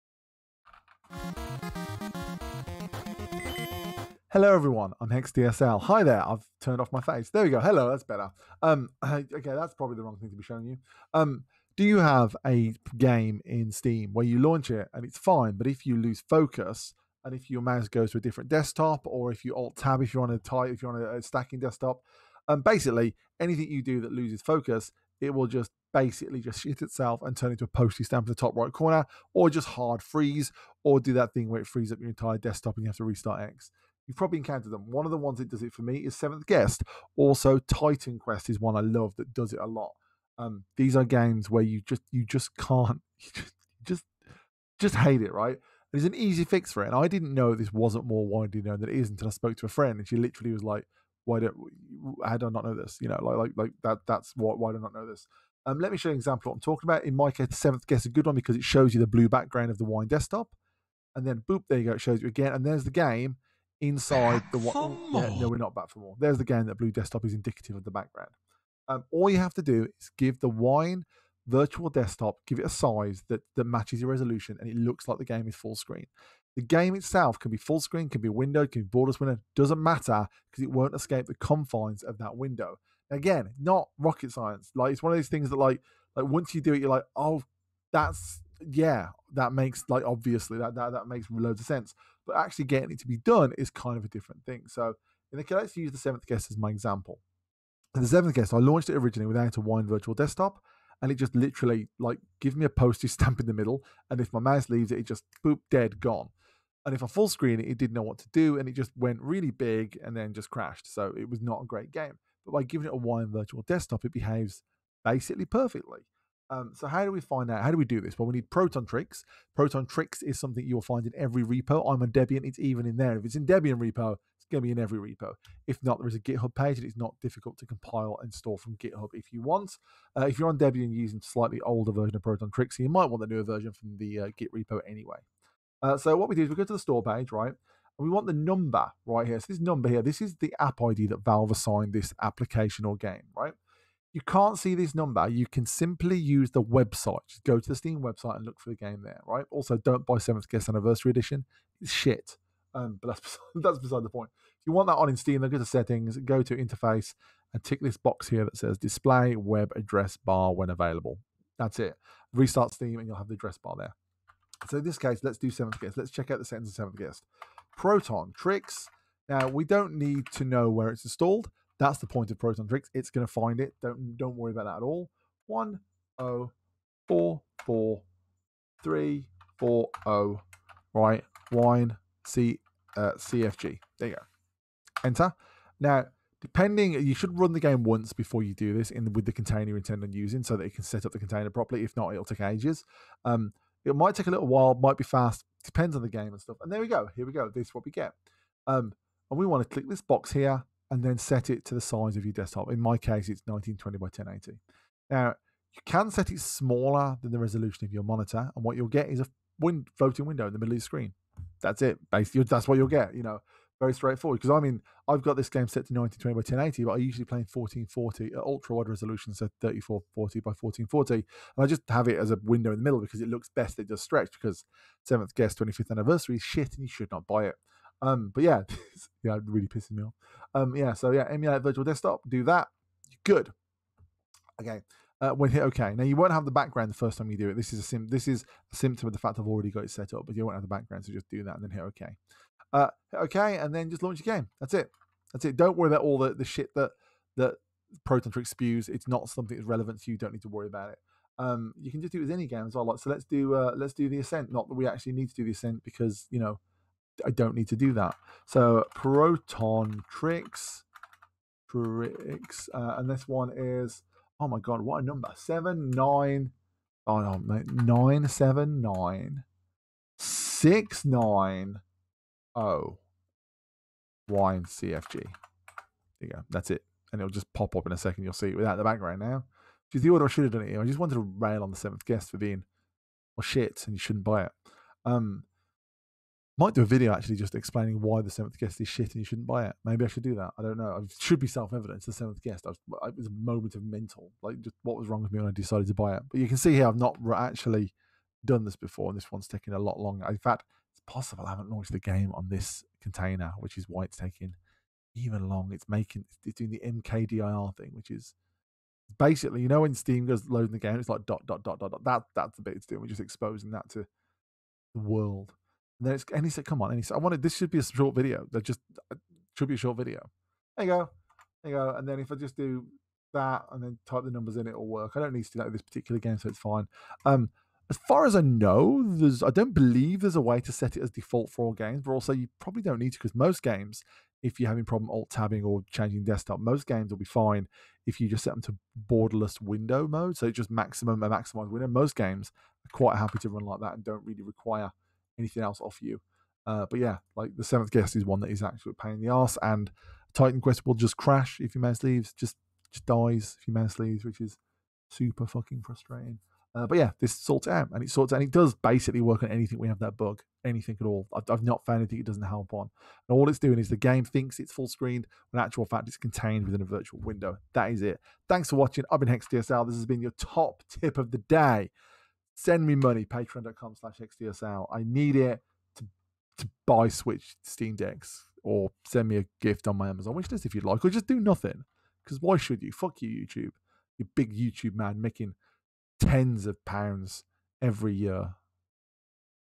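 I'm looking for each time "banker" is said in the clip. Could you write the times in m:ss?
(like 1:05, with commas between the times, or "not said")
not said.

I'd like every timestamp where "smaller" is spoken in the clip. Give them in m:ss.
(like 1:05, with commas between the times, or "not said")
3:26.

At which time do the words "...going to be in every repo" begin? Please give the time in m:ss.
2:04.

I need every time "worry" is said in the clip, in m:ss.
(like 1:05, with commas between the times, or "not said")
2:54, 4:05, 4:10.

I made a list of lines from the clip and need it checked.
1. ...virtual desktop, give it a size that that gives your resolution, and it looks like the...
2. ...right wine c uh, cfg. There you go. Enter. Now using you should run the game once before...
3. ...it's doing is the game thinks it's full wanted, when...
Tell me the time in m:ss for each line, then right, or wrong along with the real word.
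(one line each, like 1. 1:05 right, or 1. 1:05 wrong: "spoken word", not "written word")
1. 1:11 wrong: "matches", not "gives"
2. 3:00 wrong: "depending", not "using"
3. 6:03 wrong: "screened", not "wanted".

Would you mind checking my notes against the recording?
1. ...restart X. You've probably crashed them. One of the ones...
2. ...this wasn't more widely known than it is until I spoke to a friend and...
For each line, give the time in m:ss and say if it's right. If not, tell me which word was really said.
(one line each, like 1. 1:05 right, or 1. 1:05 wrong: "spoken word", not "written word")
1. 0:33 wrong: "encountered", not "crashed"
2. 0:47 right.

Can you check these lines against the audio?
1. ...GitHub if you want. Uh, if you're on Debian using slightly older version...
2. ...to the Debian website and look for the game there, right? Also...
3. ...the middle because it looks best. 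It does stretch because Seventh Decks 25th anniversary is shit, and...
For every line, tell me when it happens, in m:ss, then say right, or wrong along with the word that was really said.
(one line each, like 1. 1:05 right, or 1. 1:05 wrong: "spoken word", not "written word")
1. 2:08 right
2. 2:27 wrong: "Steam", not "Debian"
3. 3:42 wrong: "Guest", not "Decks".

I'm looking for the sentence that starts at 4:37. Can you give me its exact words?
And it'll just pop up in a second.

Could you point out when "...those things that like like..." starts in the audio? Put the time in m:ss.
1:25.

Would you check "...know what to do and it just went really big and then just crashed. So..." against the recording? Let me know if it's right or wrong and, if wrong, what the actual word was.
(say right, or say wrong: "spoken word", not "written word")
right.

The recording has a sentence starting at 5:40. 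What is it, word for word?
So just maximum a maximize window.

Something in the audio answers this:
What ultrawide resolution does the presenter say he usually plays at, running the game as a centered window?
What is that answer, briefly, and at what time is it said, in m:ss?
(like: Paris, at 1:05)
3440 by 1440, at 3:39.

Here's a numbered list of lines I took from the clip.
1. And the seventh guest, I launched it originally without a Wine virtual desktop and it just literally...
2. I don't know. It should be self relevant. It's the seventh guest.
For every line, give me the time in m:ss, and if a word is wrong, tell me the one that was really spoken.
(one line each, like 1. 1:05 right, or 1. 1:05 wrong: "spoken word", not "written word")
1. 1:37 right
2. 4:50 wrong: "evident", not "relevant".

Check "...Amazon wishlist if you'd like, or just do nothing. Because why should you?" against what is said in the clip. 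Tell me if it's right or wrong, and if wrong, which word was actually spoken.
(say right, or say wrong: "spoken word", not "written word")
right.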